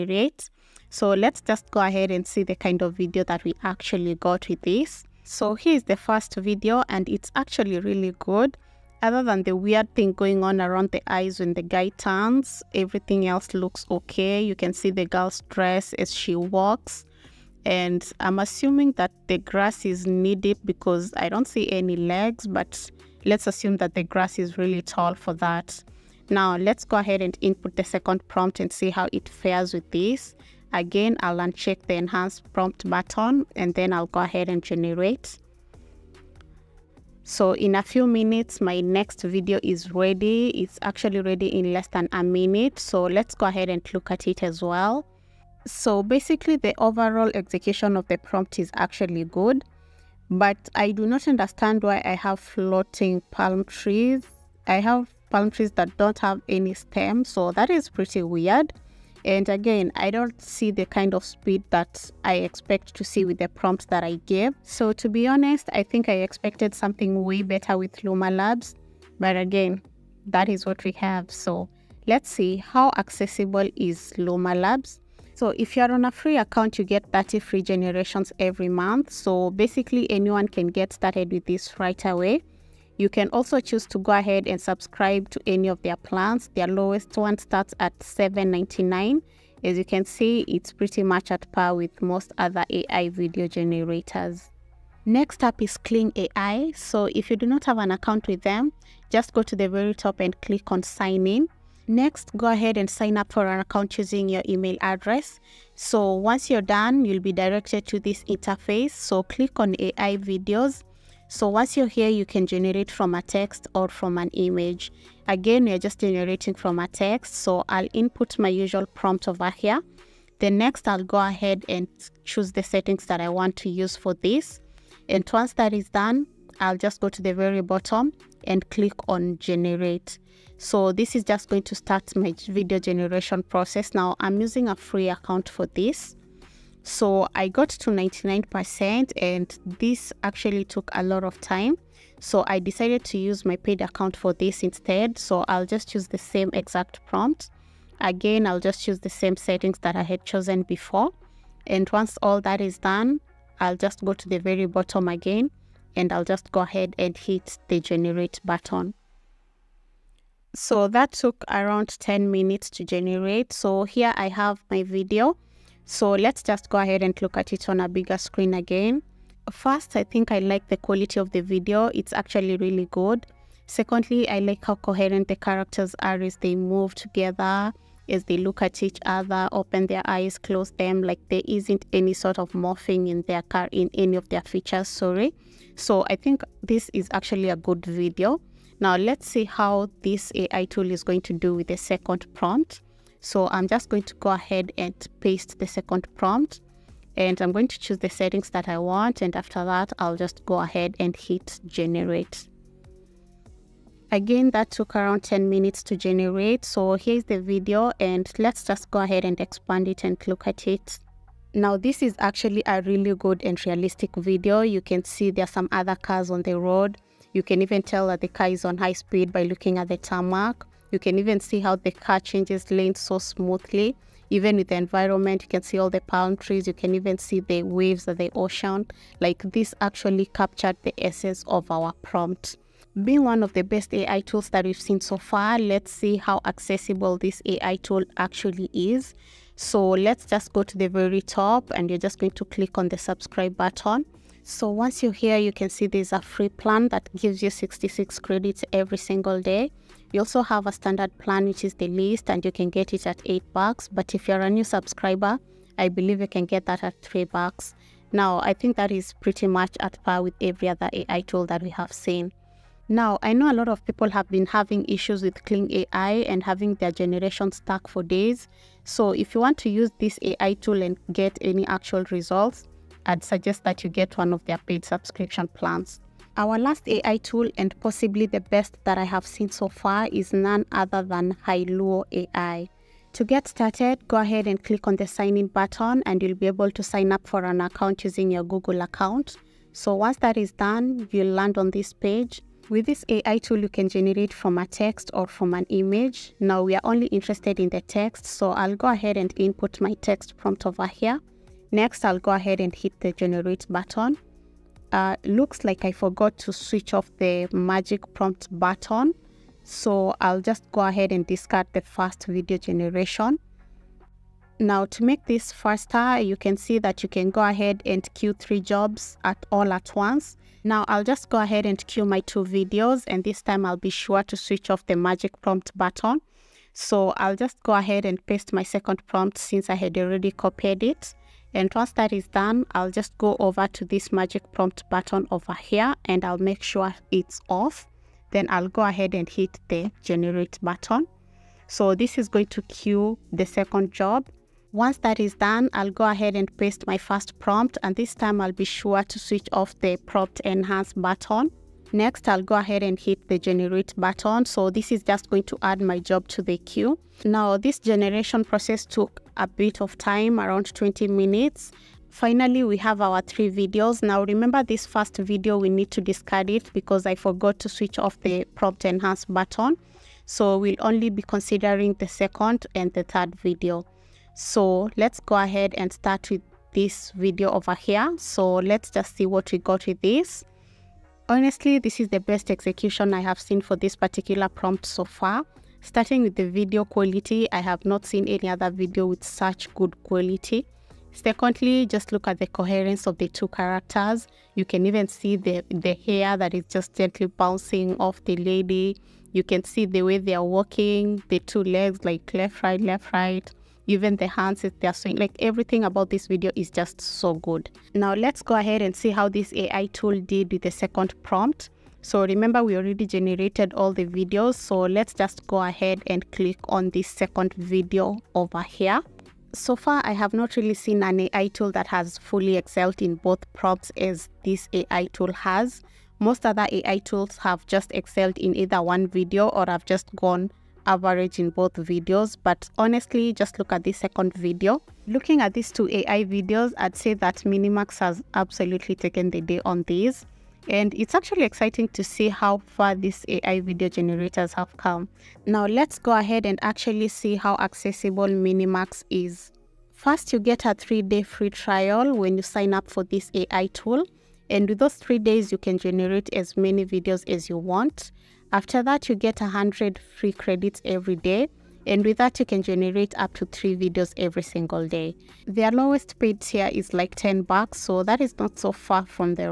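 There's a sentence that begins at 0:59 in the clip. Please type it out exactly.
And again, I don't see the kind of speed that I expect to see with the prompts that I gave.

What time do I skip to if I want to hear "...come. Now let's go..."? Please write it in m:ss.
7:24.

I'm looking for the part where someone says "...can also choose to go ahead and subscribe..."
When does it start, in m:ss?
1:23.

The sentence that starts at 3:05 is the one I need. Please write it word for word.
So I think this is actually a good video.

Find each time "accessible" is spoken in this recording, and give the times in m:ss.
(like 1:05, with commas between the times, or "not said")
1:12, 3:56, 7:27.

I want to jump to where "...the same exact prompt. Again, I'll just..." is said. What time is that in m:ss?
2:26.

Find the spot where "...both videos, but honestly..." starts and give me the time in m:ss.
7:11.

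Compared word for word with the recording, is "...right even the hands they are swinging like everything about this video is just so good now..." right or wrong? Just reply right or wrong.
right.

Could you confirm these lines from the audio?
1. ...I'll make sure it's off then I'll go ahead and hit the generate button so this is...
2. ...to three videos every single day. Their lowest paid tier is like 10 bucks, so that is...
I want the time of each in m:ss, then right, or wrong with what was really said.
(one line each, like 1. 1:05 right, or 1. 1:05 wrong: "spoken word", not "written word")
1. 5:36 right
2. 7:43 right.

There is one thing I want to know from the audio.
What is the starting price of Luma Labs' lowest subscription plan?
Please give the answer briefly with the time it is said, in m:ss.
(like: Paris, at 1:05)
7.99, at 1:27.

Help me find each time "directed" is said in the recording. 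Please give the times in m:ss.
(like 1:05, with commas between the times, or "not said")
1:47.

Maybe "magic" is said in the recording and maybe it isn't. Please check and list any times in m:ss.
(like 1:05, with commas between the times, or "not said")
5:07, 5:24, 5:34.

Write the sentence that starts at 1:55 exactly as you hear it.
Again, we're just generating from a text.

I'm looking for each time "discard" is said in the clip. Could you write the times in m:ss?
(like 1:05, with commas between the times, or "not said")
5:11, 6:06.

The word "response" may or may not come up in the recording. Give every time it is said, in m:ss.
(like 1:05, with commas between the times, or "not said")
not said.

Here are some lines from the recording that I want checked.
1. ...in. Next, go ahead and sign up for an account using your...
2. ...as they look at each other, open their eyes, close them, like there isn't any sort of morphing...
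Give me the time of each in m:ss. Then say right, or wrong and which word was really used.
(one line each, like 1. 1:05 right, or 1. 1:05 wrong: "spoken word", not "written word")
1. 1:41 right
2. 2:58 right.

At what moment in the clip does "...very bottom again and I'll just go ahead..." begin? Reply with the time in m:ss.
2:34.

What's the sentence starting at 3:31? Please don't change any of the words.
Now, this is actually a really good and realistic video.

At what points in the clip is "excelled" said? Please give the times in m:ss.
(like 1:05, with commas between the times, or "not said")
7:02, 7:07.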